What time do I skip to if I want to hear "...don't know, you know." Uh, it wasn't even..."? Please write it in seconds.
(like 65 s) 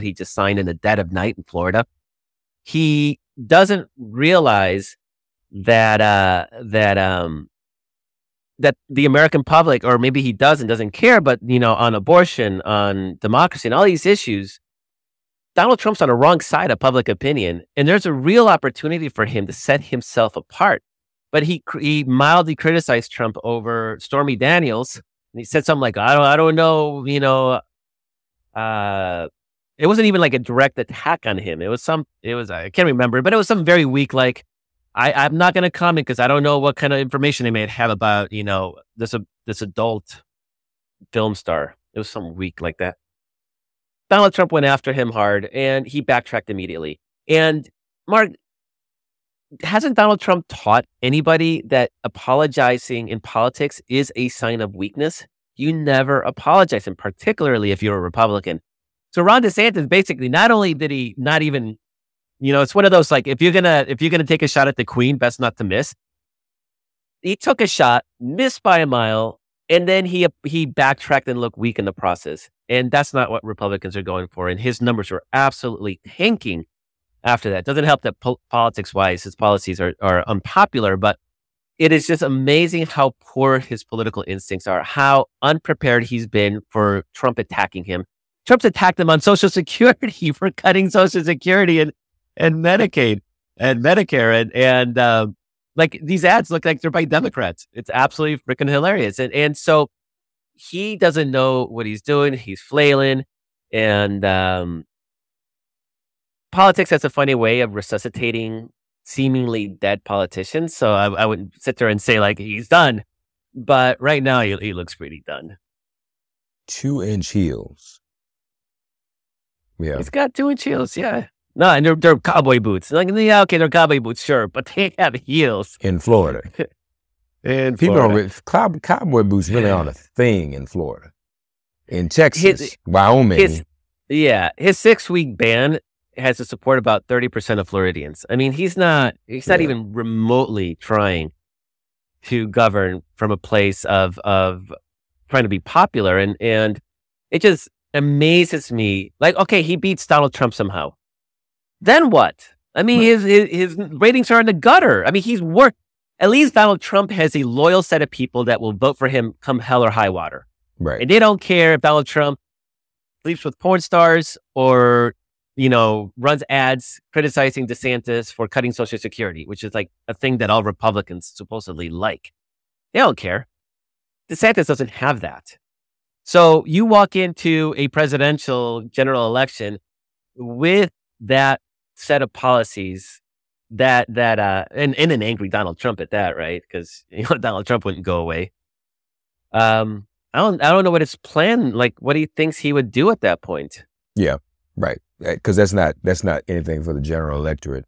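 26 s.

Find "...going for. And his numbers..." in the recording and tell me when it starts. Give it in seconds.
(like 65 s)
74 s.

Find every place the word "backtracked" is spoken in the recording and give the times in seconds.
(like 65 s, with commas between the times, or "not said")
46 s, 70 s.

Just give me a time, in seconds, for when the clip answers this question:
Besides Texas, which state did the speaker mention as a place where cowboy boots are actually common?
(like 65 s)
132 s.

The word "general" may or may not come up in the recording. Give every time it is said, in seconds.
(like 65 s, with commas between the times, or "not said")
178 s, 197 s.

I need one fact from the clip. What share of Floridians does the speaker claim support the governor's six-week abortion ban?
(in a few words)
30%.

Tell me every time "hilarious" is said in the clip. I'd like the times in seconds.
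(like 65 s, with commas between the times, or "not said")
98 s.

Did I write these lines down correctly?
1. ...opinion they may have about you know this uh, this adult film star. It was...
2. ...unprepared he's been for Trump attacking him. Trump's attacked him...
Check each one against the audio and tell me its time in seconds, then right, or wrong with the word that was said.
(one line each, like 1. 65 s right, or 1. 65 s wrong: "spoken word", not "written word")
1. 36 s wrong: "information", not "opinion"
2. 85 s right.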